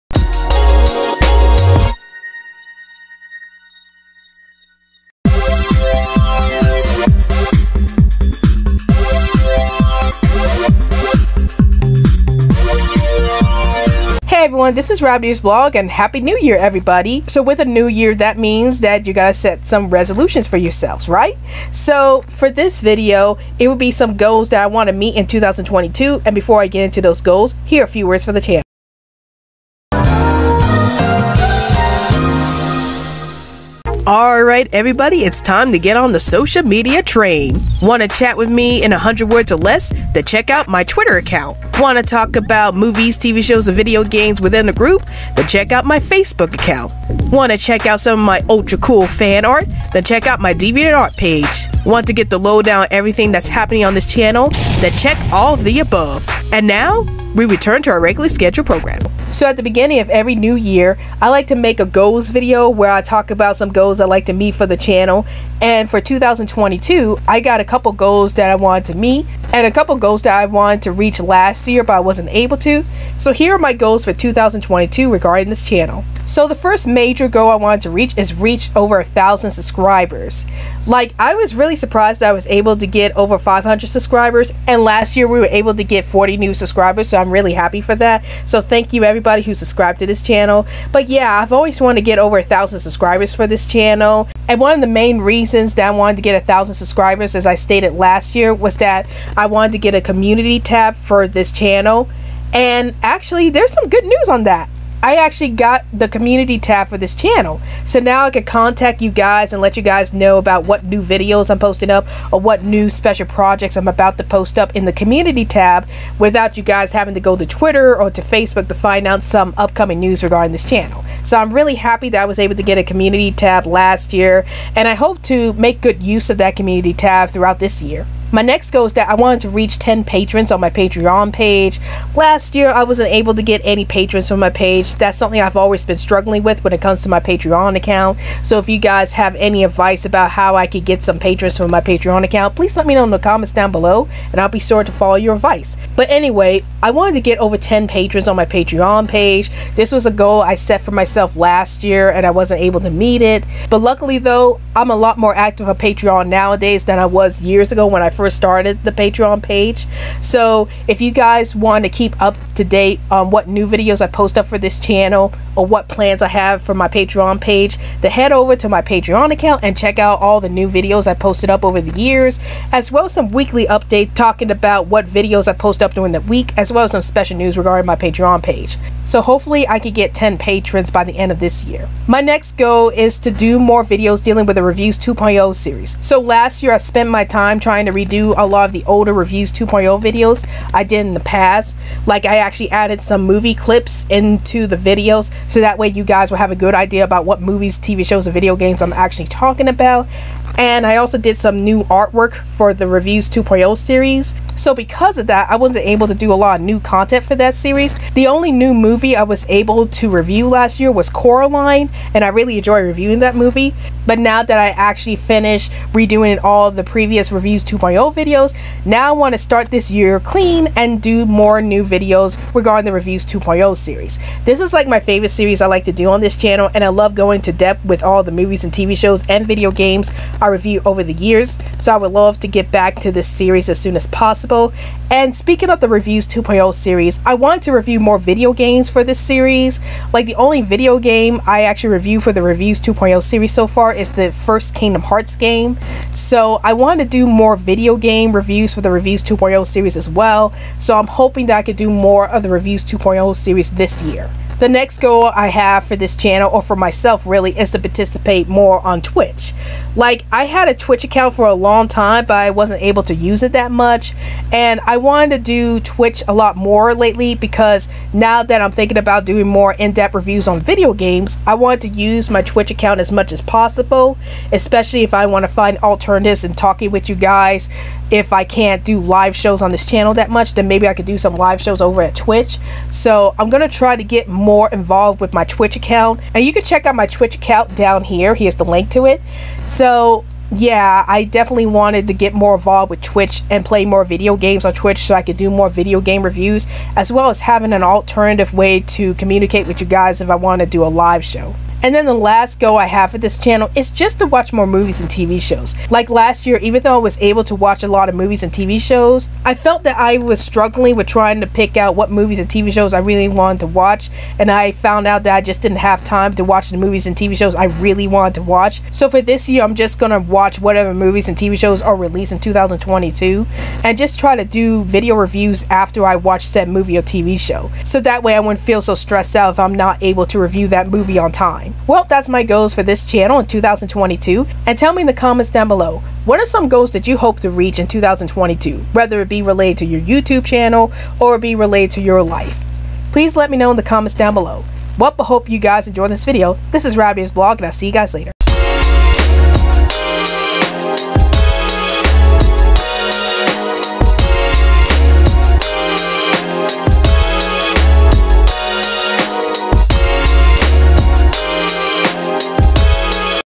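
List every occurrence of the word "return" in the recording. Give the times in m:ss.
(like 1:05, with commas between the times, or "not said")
0:57.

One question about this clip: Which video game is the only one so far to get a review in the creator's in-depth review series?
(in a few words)
Kingdom Hearts.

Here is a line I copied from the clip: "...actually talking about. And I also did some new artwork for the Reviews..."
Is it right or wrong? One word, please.
right.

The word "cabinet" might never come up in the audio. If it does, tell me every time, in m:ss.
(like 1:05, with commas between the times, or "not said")
not said.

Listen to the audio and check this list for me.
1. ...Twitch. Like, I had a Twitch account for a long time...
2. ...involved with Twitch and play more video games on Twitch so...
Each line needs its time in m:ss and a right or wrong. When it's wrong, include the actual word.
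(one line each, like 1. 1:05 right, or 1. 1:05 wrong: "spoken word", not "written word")
1. 4:19 right
2. 4:52 right.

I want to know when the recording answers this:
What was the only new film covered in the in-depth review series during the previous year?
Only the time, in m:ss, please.
3:31.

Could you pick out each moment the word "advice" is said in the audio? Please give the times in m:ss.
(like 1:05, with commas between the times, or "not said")
2:19, 2:25.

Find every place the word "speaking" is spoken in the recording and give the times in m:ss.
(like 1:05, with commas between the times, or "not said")
3:55.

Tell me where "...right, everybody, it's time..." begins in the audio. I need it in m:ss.
0:34.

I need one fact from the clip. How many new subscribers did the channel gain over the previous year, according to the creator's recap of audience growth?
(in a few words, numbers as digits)
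40.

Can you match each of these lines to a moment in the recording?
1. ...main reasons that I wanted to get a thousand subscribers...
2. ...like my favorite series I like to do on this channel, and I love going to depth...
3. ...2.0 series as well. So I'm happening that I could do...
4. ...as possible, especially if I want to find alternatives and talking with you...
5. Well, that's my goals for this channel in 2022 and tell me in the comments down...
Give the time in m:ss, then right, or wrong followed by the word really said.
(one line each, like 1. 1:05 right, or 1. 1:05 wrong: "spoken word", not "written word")
1. 1:34 right
2. 3:44 right
3. 4:09 wrong: "hoping", not "happening"
4. 4:33 right
5. 5:31 right.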